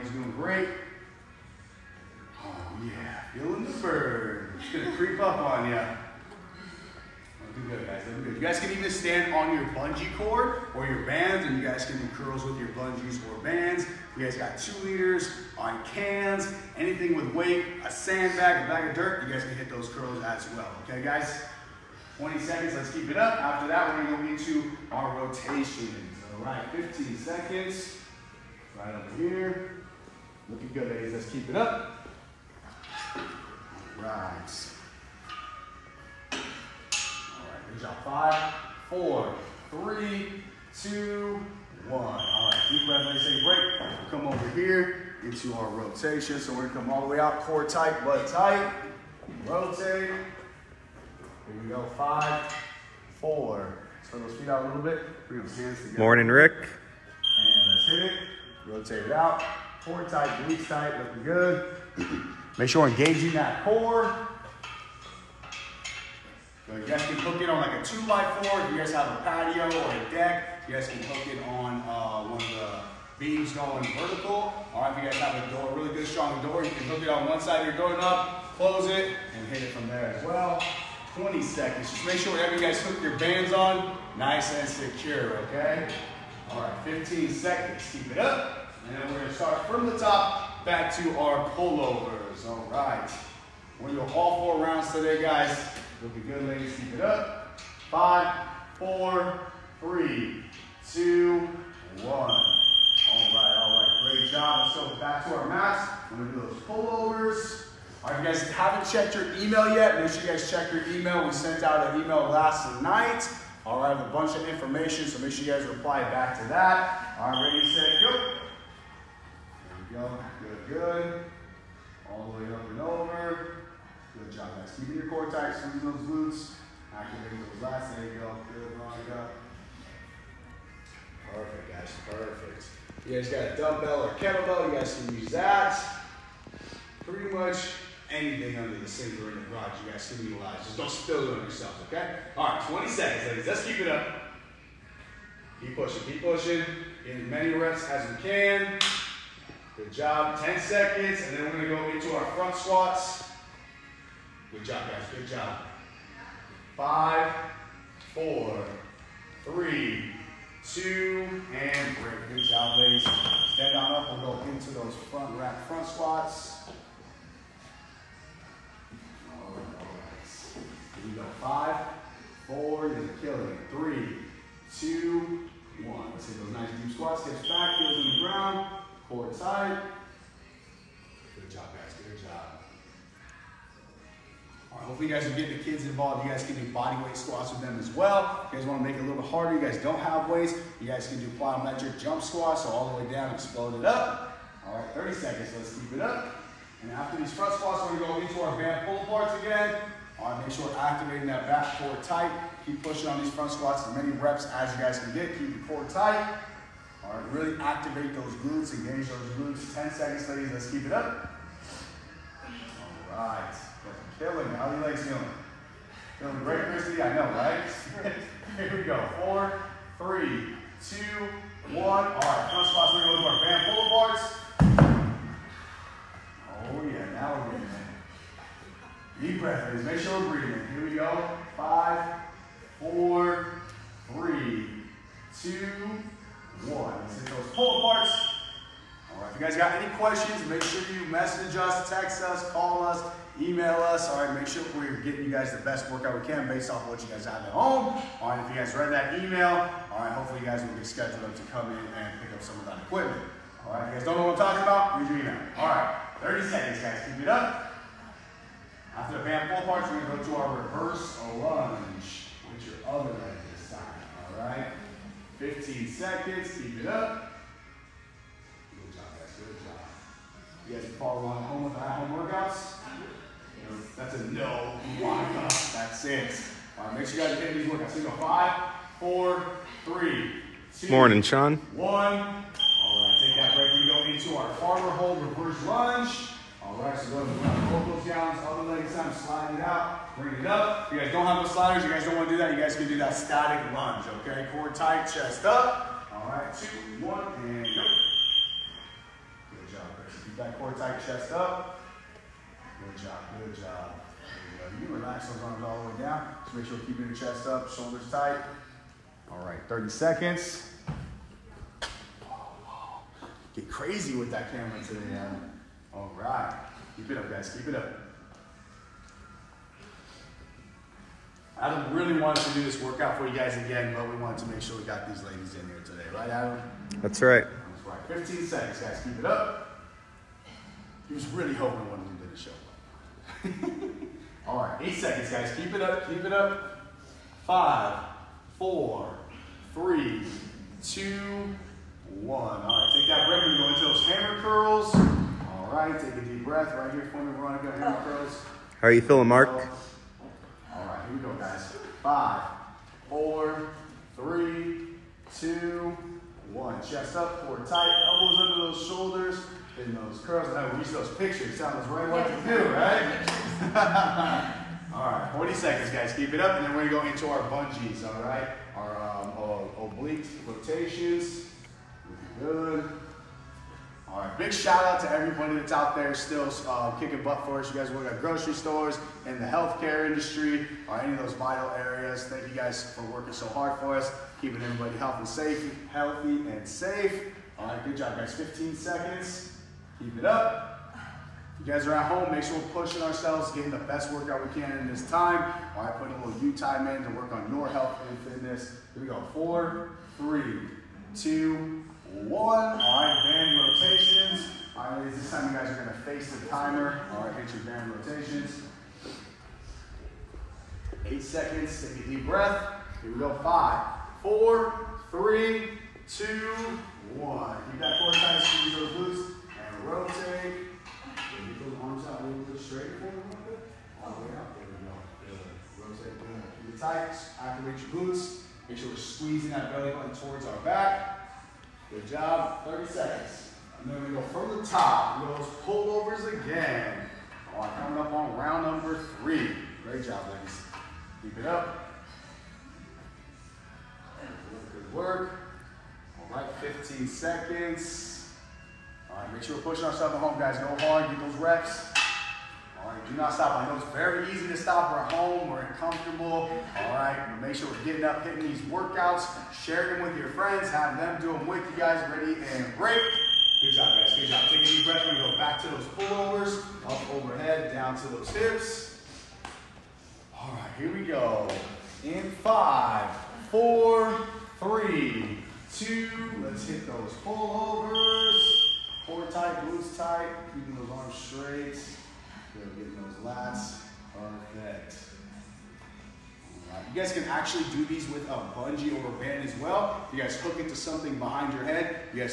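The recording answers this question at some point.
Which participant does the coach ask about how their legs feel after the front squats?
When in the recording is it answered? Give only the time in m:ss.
3:36.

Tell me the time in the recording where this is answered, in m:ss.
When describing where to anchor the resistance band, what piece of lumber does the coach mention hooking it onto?
1:07.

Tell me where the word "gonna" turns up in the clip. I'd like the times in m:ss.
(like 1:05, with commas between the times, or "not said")
0:24, 0:46, 1:29, 1:33, 3:17, 4:20, 6:06, 6:45.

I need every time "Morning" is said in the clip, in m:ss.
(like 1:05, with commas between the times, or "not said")
0:55, 4:40.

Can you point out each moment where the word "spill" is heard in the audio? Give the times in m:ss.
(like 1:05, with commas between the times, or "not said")
2:20.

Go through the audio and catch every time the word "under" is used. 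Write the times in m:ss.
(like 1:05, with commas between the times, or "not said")
2:18, 5:58.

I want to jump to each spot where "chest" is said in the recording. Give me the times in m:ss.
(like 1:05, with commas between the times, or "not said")
4:55, 5:01, 5:07, 5:56.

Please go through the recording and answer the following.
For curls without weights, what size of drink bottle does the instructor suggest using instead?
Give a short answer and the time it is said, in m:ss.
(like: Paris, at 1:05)
Two liters, at 0:14.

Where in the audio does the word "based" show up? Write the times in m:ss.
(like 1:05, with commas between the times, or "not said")
4:06.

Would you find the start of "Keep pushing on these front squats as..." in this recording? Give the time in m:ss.
3:22.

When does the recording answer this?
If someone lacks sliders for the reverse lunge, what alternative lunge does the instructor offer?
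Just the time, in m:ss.
4:53.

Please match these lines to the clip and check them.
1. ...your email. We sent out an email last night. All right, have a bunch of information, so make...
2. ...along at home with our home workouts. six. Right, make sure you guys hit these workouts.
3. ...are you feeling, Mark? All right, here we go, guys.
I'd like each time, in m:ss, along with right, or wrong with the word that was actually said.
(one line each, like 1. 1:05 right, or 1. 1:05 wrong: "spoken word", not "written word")
1. 1:50 right
2. 4:31 right
3. 5:48 right.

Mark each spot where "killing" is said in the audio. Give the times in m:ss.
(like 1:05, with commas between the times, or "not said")
2:53, 3:34.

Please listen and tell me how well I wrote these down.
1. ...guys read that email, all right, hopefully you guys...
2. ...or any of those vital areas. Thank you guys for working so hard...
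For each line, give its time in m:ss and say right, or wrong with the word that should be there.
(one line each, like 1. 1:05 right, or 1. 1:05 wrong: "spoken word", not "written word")
1. 4:08 right
2. 6:20 right.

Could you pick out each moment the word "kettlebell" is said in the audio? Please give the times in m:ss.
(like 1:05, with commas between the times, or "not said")
2:14.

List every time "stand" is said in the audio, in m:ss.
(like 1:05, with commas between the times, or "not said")
0:08, 2:43.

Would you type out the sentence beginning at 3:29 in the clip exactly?
10 seconds, ladies, let's keep it up.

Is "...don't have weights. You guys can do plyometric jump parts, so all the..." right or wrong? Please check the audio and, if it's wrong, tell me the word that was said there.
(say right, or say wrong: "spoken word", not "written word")
wrong: "squats", not "parts".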